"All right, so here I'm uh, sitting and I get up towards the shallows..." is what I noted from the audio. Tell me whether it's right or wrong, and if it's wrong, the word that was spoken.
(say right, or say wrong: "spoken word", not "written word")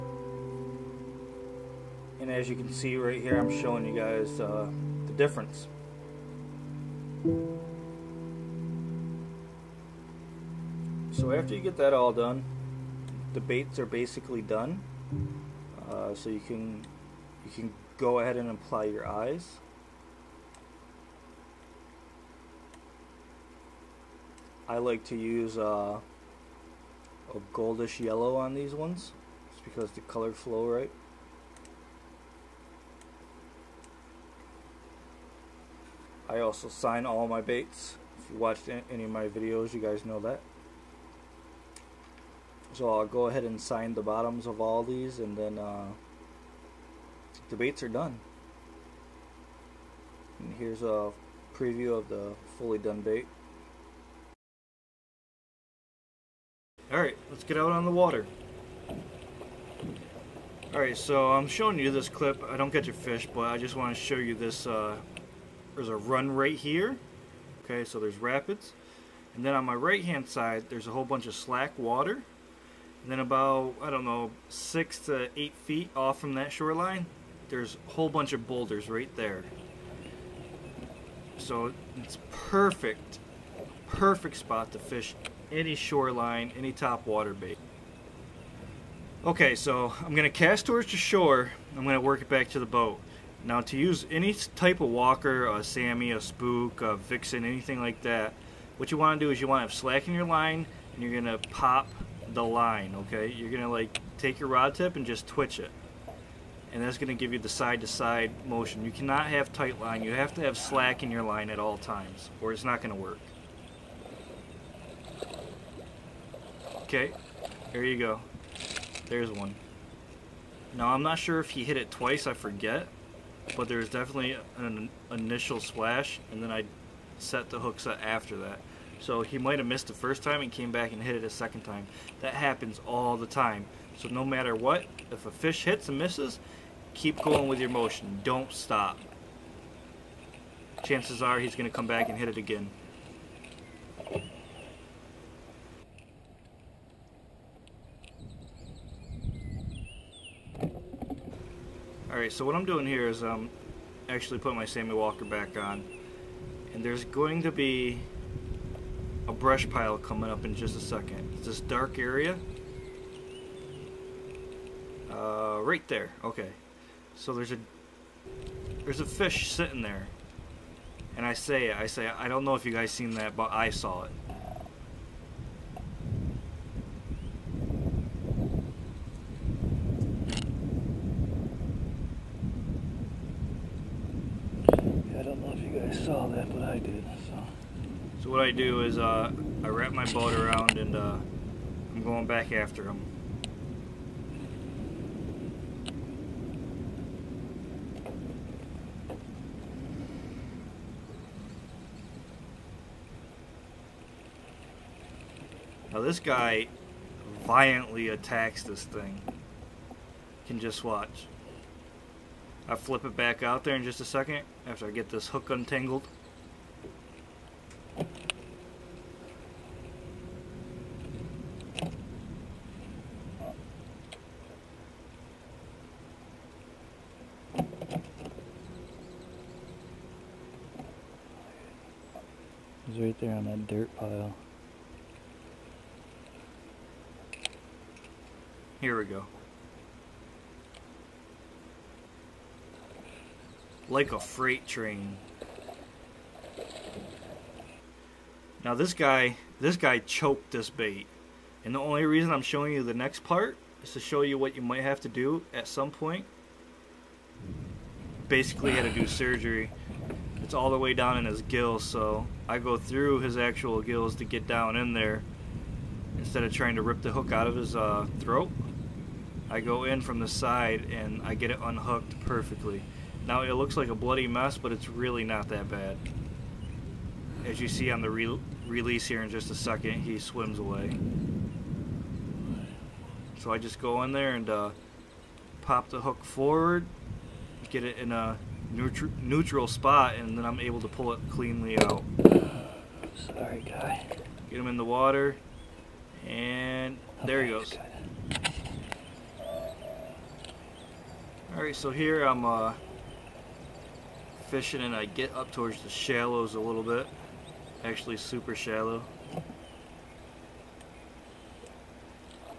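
wrong: "fishing", not "sitting".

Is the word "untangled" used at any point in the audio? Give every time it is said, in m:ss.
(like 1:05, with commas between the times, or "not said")
3:35.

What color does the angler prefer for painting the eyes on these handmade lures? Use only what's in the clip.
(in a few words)
goldish yellow.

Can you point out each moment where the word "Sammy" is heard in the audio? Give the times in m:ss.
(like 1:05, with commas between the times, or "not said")
1:35, 2:34.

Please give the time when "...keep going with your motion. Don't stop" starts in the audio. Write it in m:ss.
2:16.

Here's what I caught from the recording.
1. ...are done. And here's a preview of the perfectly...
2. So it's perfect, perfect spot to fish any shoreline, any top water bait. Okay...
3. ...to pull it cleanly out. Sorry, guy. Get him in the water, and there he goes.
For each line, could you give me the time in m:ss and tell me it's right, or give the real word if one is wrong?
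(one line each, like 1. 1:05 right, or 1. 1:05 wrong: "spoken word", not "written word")
1. 0:47 wrong: "fully", not "perfectly"
2. 1:21 right
3. 4:50 right.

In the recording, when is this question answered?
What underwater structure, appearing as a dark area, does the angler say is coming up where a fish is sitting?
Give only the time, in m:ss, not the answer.
2:39.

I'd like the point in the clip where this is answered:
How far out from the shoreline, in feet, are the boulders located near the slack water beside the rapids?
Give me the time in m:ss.
1:14.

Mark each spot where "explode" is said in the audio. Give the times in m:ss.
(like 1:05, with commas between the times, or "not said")
not said.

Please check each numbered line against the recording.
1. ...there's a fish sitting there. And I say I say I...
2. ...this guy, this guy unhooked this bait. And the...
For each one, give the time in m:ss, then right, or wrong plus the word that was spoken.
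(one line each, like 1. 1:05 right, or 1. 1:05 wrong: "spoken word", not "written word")
1. 2:48 right
2. 4:08 wrong: "choked", not "unhooked".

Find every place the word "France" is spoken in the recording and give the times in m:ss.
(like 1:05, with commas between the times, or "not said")
not said.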